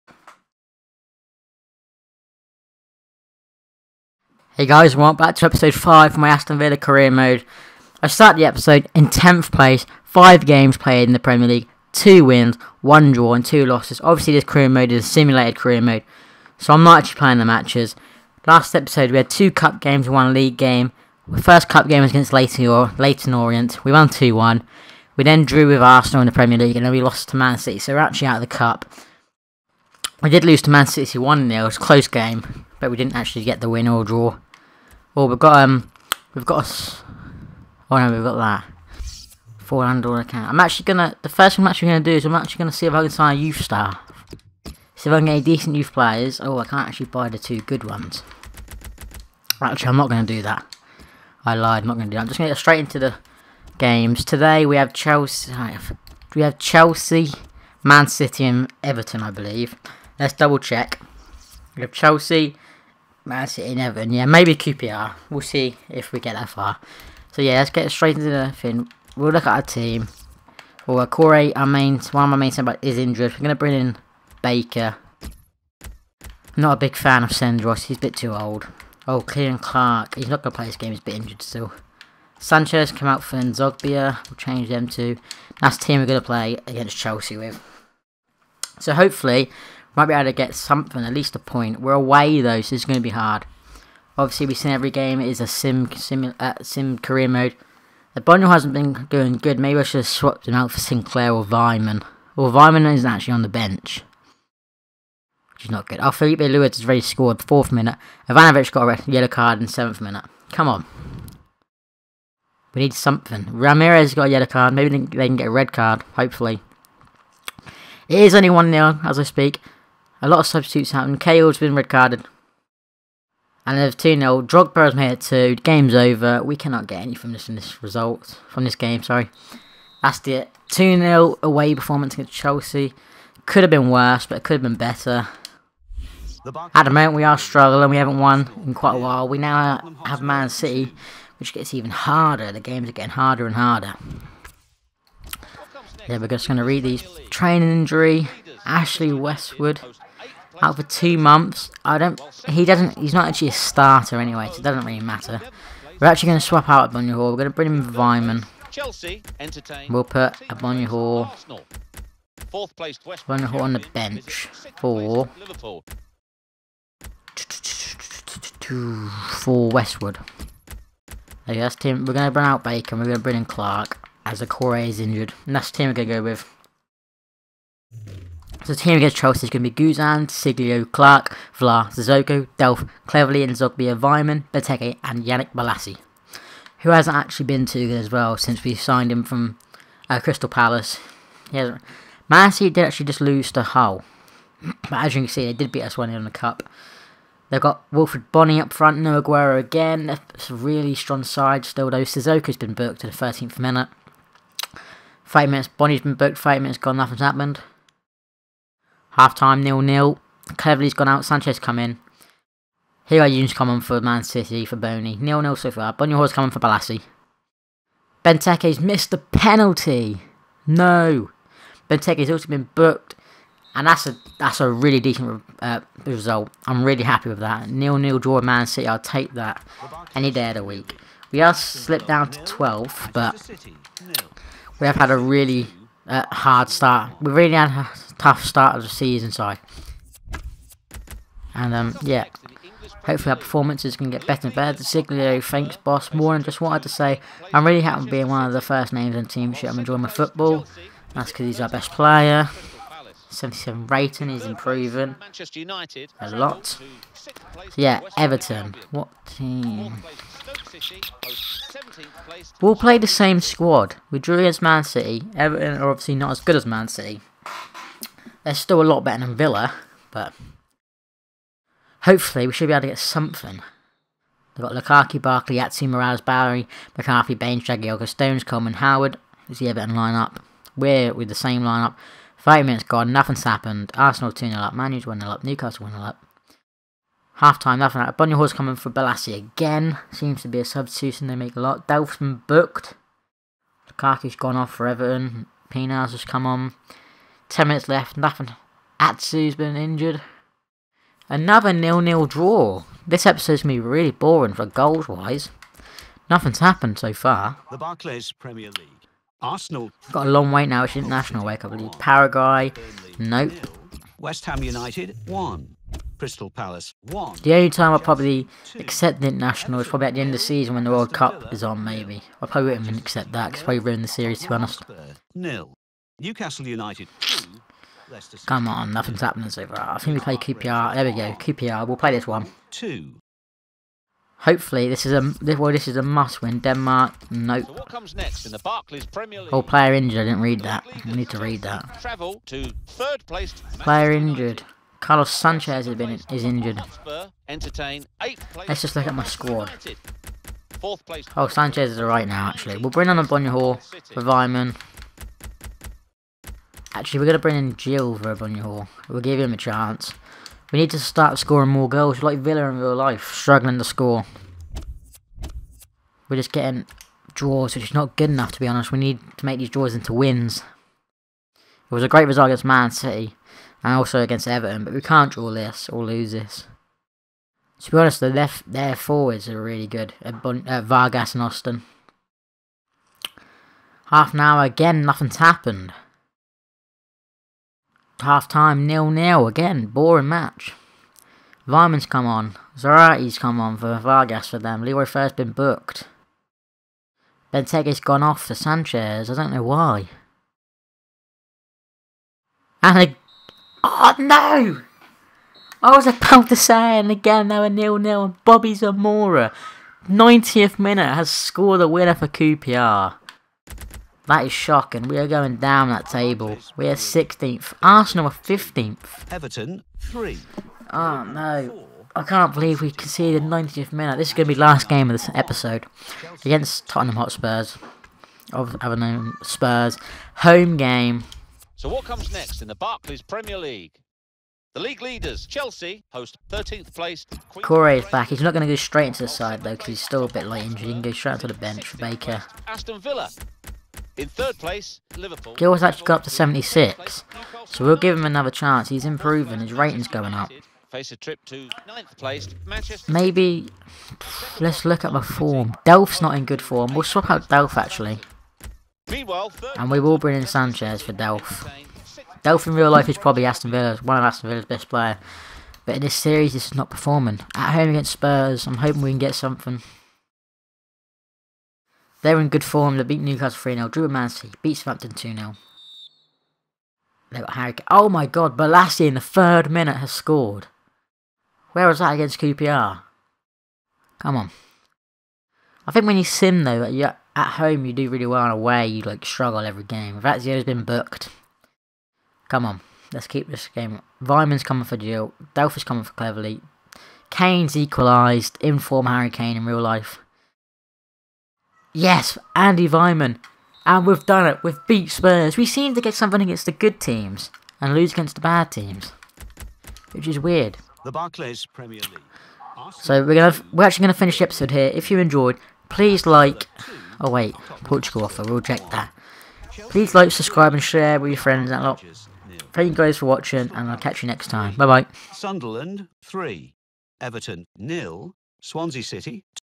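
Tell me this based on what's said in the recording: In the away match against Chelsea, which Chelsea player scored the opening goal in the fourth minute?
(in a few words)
Filipe Luís.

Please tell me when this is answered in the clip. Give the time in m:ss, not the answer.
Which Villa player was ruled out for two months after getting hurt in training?
2:28.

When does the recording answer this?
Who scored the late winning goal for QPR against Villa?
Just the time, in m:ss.
6:48.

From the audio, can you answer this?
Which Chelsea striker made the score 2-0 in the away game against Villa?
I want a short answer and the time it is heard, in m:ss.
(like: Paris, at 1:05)
Drogba, at 2:04.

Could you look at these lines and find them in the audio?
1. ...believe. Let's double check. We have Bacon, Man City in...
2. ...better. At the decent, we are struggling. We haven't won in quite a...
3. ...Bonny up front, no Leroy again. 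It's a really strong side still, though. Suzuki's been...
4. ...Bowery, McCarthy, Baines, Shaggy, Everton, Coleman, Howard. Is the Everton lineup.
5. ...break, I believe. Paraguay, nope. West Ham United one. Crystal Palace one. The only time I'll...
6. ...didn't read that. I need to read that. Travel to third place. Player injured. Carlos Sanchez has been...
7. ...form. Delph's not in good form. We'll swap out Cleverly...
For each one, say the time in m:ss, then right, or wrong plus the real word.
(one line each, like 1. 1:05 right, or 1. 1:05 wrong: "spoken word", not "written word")
1. 0:59 wrong: "Chelsea", not "Bacon"
2. 2:14 wrong: "moment", not "decent"
3. 3:18 wrong: "Aguero", not "Leroy"
4. 4:36 wrong: "Stones", not "Everton"
5. 5:11 right
6. 5:40 right
7. 7:35 wrong: "Delph", not "Cleverly".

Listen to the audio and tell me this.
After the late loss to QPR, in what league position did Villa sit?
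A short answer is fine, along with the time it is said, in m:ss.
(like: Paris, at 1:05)
16th, at 6:56.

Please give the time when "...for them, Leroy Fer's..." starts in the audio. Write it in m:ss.
6:34.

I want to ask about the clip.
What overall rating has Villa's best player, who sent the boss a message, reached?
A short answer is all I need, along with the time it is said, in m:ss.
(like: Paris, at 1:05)
77, at 4:13.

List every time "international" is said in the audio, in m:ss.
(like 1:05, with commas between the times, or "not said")
5:10, 5:19.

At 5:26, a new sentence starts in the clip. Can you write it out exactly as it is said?
Newcastle United Come on, nothing's happening so far.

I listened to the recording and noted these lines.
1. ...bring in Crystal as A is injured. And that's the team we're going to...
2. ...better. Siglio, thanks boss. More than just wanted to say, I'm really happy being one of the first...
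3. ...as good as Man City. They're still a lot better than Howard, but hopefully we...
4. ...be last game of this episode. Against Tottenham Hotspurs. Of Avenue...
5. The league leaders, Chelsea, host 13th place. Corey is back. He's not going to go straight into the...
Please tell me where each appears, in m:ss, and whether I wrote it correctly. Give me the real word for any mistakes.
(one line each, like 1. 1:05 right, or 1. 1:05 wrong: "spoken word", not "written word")
1. 2:53 wrong: "Clark", not "Crystal"
2. 4:04 right
3. 4:26 wrong: "Villa", not "Howard"
4. 7:04 right
5. 7:14 right.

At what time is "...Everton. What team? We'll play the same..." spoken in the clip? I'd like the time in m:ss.
4:18.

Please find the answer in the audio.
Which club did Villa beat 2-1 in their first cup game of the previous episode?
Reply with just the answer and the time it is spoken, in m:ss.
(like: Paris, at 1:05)
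Leyton Orient, at 0:22.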